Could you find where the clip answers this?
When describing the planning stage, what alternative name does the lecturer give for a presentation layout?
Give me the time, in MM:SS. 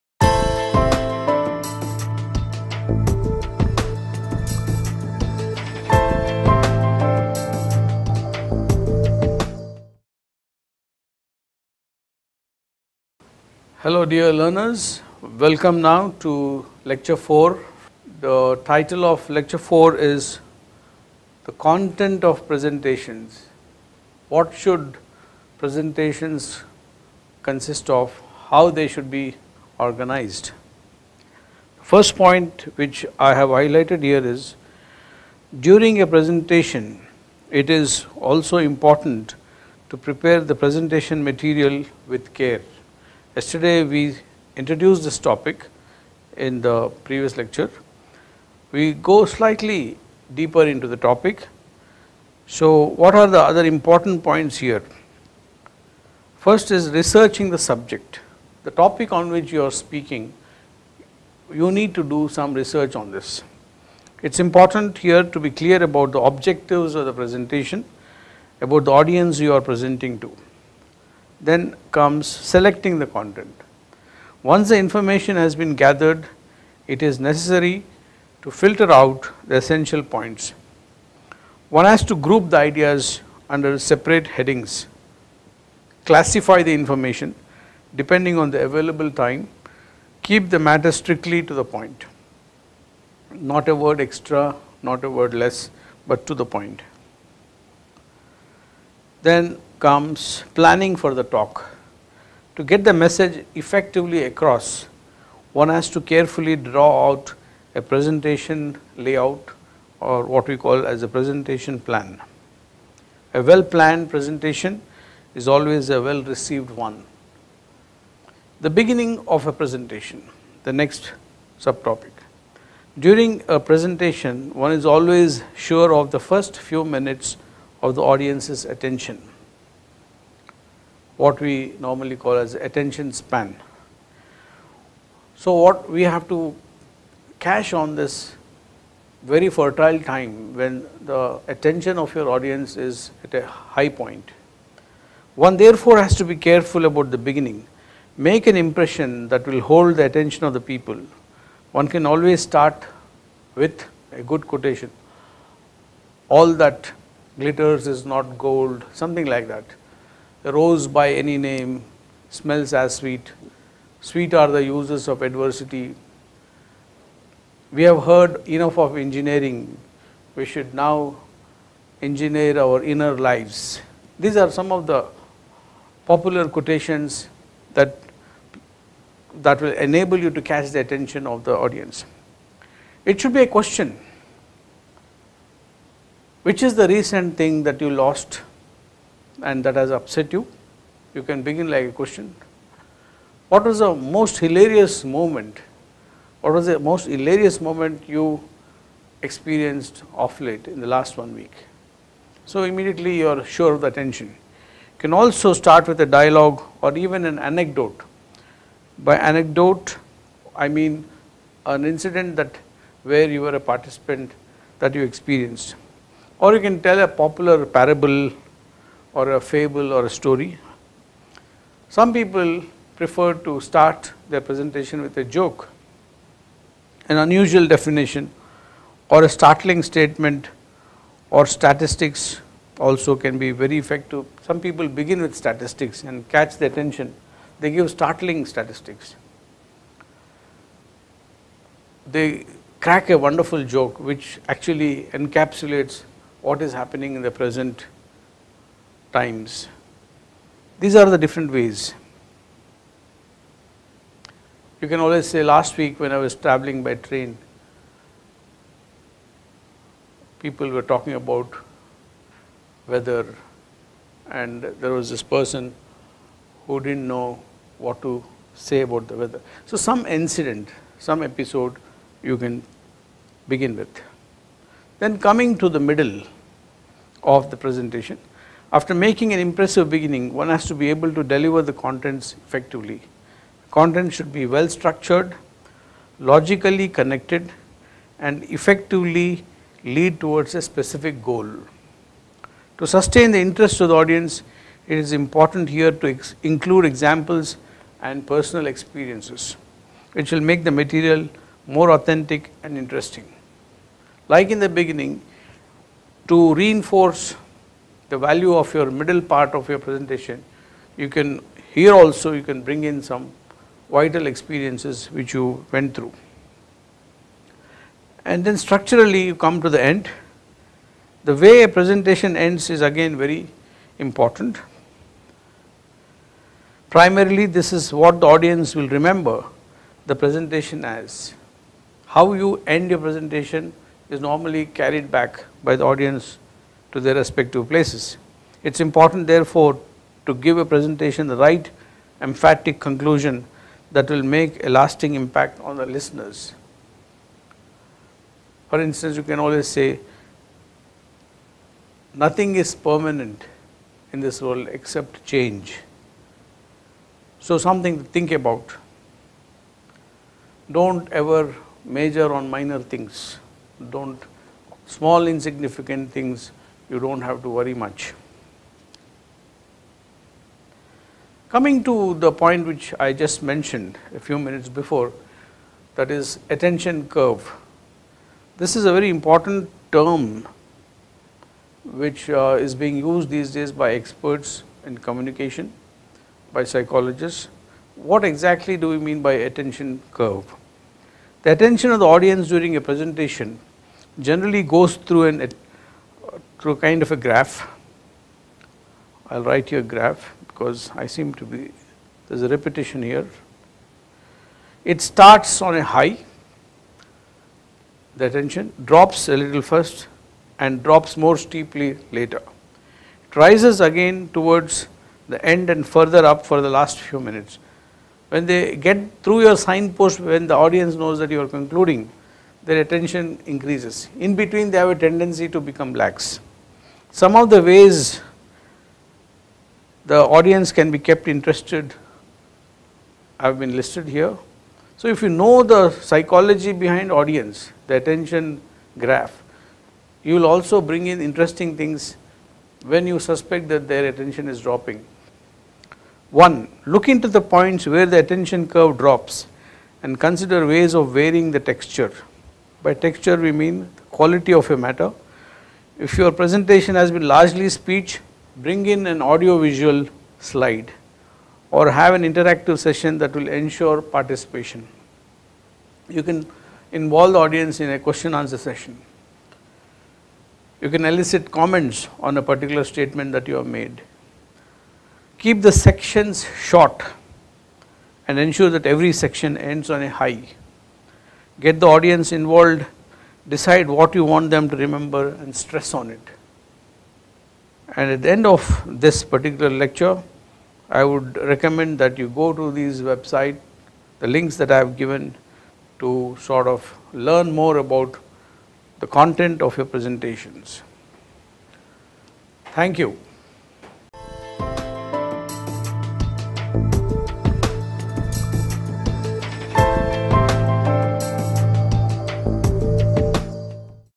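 01:51.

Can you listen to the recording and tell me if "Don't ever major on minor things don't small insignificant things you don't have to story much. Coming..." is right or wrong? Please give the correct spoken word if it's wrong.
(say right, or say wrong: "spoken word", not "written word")
wrong: "worry", not "story".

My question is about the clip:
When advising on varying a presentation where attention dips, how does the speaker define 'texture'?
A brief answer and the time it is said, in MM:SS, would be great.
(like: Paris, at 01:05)
quality of a matter, at 07:34.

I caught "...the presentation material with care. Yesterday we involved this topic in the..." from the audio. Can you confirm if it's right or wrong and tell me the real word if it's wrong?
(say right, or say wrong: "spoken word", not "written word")
wrong: "introduced", not "involved".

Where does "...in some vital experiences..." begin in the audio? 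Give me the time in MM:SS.
05:12.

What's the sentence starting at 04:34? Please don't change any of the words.
Then, coming to the middle, of the presentation.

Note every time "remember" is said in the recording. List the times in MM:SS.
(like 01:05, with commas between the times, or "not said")
05:28, 08:04.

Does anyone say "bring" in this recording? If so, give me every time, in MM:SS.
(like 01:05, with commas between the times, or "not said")
05:12, 07:20, 07:38.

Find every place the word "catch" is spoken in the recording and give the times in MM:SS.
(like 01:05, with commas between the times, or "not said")
03:00, 03:56.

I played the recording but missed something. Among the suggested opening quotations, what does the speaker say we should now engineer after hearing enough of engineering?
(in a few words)
our inner lives.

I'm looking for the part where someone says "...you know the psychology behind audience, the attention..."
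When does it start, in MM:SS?
07:15.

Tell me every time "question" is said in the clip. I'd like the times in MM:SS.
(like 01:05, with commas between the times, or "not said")
03:03, 03:11, 07:47.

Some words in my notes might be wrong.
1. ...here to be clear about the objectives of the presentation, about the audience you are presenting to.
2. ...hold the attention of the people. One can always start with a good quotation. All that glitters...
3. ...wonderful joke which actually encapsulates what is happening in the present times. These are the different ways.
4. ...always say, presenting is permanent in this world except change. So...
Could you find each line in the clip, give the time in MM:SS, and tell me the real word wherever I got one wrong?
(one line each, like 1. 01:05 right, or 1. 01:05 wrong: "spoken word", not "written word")
1. 01:04 right
2. 02:29 right
3. 04:03 right
4. 05:49 wrong: "nothing", not "presenting".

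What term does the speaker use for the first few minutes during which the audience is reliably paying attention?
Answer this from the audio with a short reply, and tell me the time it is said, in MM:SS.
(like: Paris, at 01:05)
attention span, at 02:12.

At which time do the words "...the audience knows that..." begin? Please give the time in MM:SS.
07:00.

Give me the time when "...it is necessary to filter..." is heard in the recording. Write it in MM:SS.
01:16.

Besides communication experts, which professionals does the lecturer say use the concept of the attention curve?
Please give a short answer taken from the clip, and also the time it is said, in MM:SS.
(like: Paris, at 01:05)
psychologists, at 06:26.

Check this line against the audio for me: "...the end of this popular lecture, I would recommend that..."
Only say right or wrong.
wrong.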